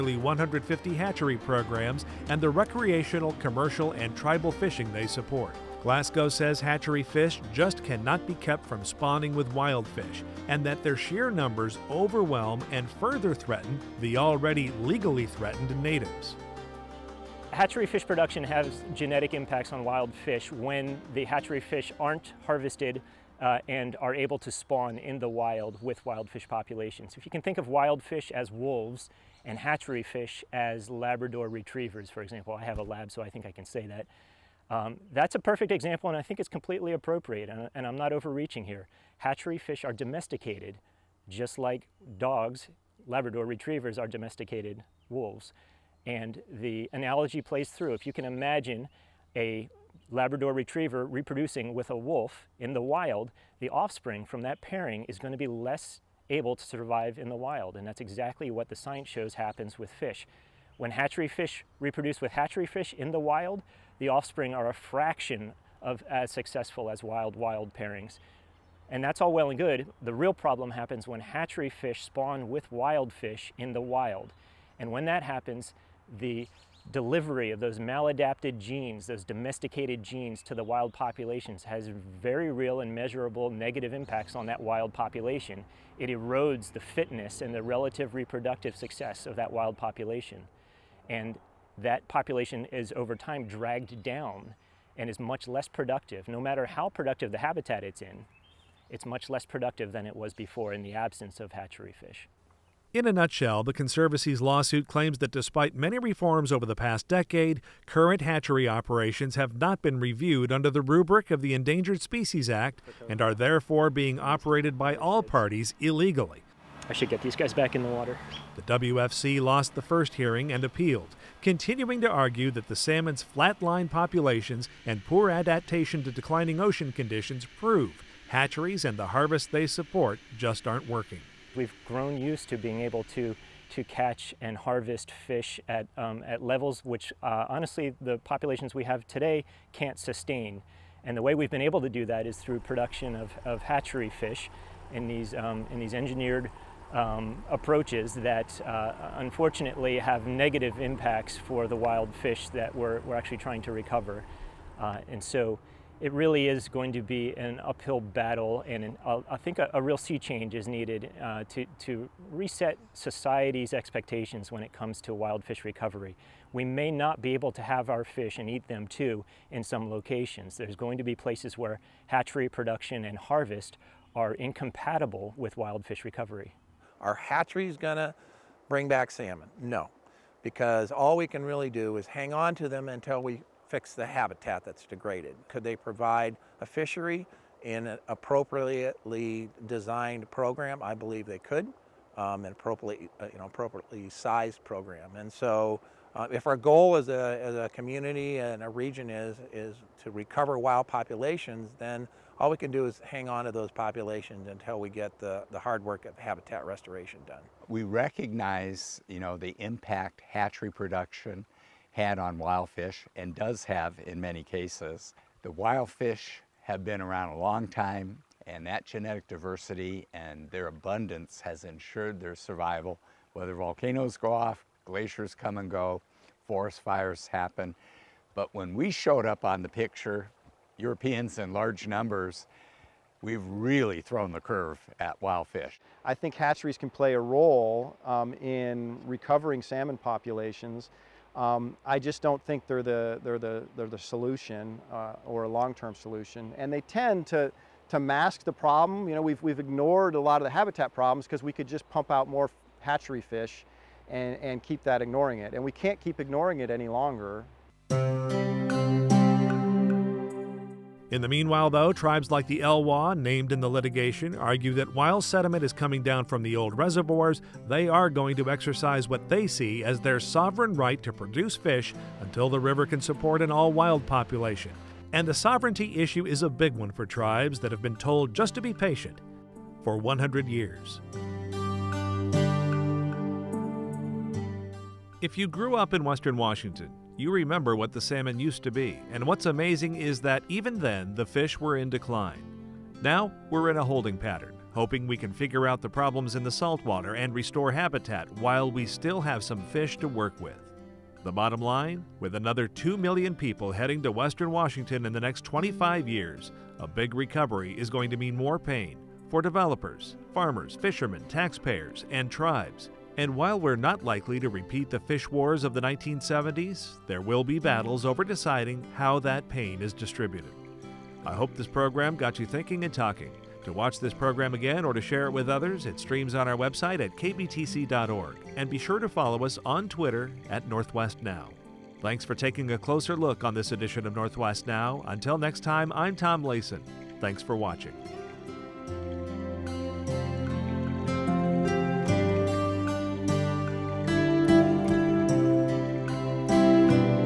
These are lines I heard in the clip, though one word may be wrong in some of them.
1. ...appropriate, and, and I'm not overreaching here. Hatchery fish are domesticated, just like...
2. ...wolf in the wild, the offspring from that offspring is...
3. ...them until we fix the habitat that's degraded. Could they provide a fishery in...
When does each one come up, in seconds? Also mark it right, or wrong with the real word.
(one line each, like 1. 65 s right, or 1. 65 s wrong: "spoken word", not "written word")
1. 36 s right
2. 51 s wrong: "pairing", not "offspring"
3. 182 s right.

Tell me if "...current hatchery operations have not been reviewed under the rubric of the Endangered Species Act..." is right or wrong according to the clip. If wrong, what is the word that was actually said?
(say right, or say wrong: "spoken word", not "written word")
right.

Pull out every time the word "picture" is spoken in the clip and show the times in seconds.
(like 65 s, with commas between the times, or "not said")
229 s.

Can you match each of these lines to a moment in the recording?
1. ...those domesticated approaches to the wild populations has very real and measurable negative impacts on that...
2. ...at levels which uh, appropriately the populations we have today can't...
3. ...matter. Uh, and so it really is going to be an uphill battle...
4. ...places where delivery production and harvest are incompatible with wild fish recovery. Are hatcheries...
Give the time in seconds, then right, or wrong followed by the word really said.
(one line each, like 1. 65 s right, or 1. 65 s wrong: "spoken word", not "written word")
1. 79 s wrong: "genes", not "approaches"
2. 136 s wrong: "honestly", not "appropriately"
3. 153 s wrong: "recover", not "matter"
4. 171 s wrong: "hatchery", not "delivery".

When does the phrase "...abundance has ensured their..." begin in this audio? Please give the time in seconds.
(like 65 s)
220 s.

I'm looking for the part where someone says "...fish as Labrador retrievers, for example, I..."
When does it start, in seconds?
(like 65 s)
30 s.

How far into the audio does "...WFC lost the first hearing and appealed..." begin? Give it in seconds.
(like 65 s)
118 s.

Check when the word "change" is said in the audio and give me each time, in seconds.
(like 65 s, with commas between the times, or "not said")
160 s.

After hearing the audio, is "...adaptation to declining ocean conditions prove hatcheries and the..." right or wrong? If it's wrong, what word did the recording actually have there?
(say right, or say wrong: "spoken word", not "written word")
right.